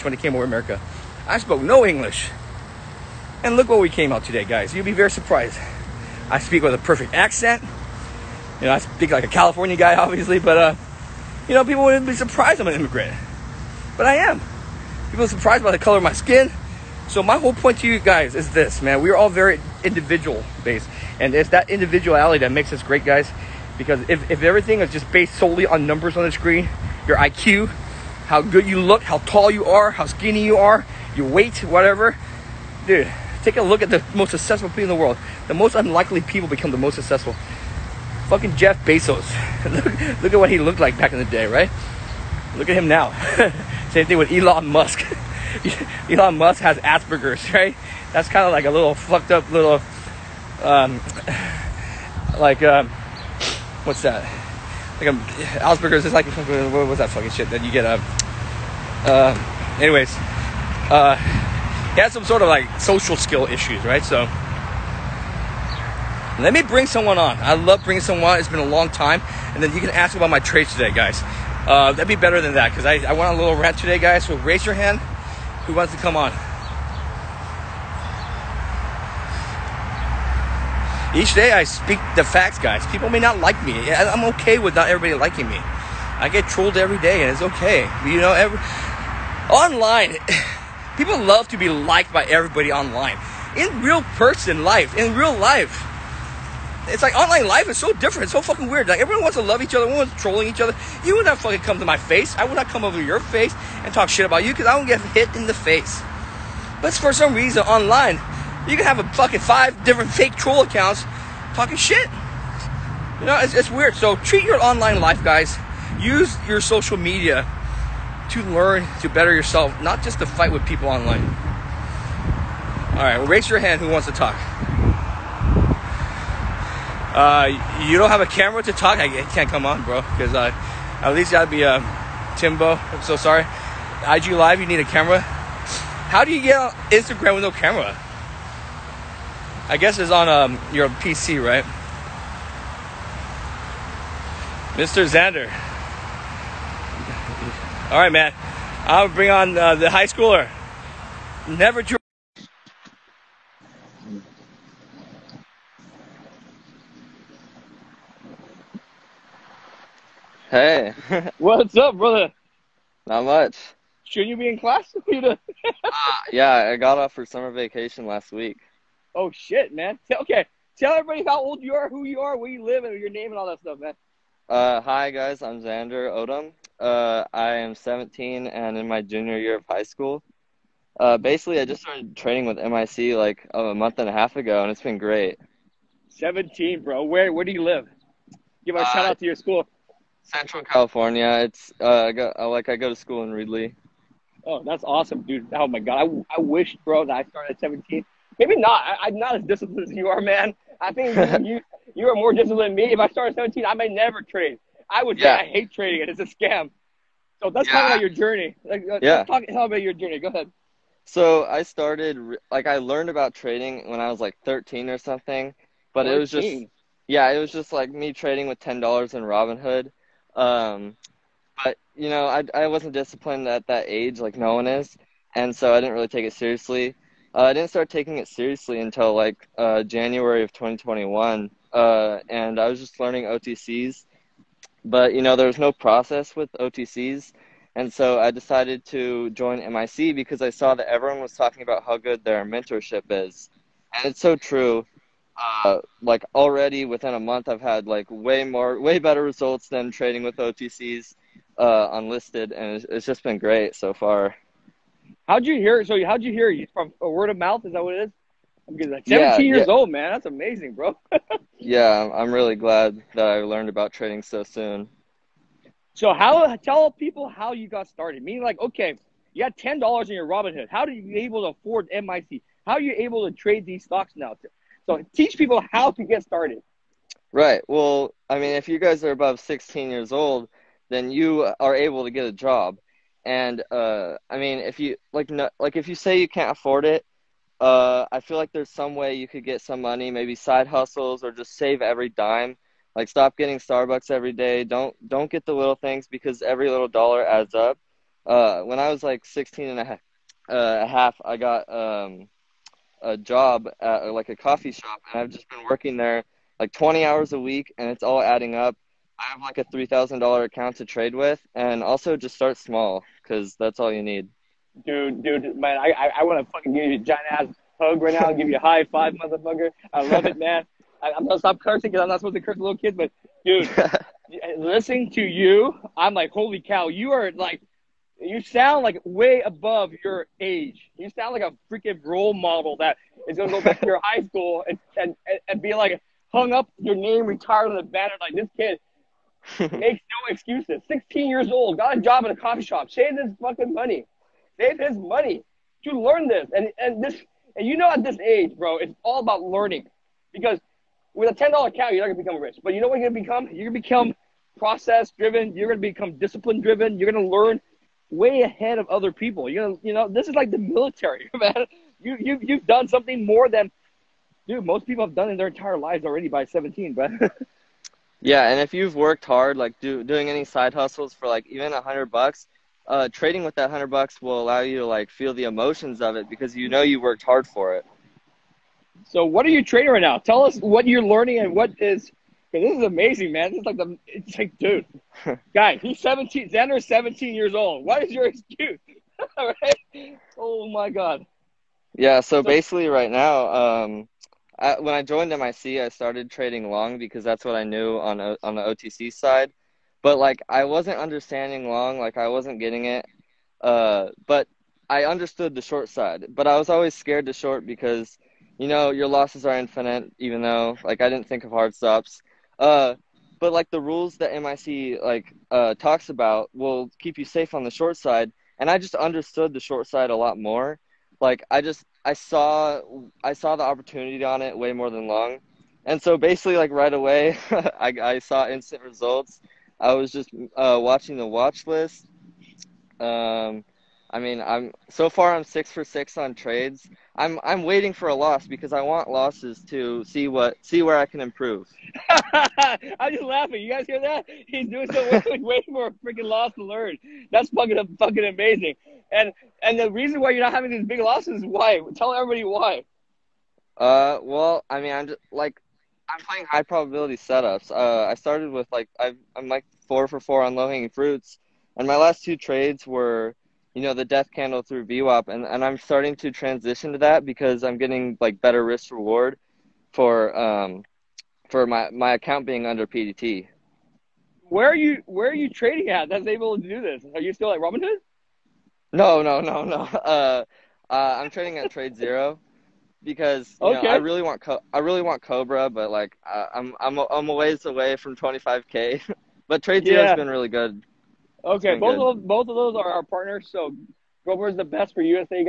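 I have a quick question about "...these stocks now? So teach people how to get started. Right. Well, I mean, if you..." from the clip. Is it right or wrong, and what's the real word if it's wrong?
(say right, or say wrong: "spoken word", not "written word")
right.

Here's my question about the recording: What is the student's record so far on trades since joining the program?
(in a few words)
Six for six.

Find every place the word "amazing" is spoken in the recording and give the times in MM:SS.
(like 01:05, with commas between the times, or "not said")
04:20, 06:22, 07:28.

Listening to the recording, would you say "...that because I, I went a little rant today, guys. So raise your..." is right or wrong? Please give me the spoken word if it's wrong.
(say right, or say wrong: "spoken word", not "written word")
right.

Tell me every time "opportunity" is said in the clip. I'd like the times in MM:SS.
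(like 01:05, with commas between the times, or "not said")
07:03.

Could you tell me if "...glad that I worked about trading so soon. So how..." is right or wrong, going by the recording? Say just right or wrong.
wrong.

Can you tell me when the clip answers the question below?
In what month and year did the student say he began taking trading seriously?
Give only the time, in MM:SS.
03:49.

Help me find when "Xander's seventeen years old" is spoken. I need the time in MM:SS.
06:26.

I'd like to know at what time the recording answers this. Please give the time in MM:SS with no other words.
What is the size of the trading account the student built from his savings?
05:09.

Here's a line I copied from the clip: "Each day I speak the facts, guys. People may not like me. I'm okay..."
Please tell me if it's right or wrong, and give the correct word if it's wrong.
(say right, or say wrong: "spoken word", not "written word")
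right.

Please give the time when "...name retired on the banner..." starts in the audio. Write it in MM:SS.
05:36.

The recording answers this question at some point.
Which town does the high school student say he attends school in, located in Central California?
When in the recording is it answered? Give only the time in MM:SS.
03:13.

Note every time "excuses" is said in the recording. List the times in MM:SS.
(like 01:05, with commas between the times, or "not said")
05:40, 06:28.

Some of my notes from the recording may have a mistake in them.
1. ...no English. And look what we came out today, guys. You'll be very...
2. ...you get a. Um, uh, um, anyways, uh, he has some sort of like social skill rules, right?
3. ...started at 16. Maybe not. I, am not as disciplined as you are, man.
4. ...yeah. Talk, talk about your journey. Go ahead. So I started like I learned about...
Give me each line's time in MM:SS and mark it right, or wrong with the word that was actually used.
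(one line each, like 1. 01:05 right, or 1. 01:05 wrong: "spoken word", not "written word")
1. 00:01 right
2. 00:57 wrong: "issues", not "rules"
3. 03:17 wrong: "17", not "16"
4. 03:29 right.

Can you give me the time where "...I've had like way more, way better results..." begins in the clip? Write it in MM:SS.
04:07.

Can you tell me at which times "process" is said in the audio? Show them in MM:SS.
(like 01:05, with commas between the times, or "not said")
03:55, 05:54.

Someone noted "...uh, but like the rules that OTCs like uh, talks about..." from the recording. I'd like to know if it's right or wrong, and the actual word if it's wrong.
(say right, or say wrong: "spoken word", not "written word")
wrong: "MIC", not "OTCs".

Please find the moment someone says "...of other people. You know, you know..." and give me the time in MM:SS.
05:58.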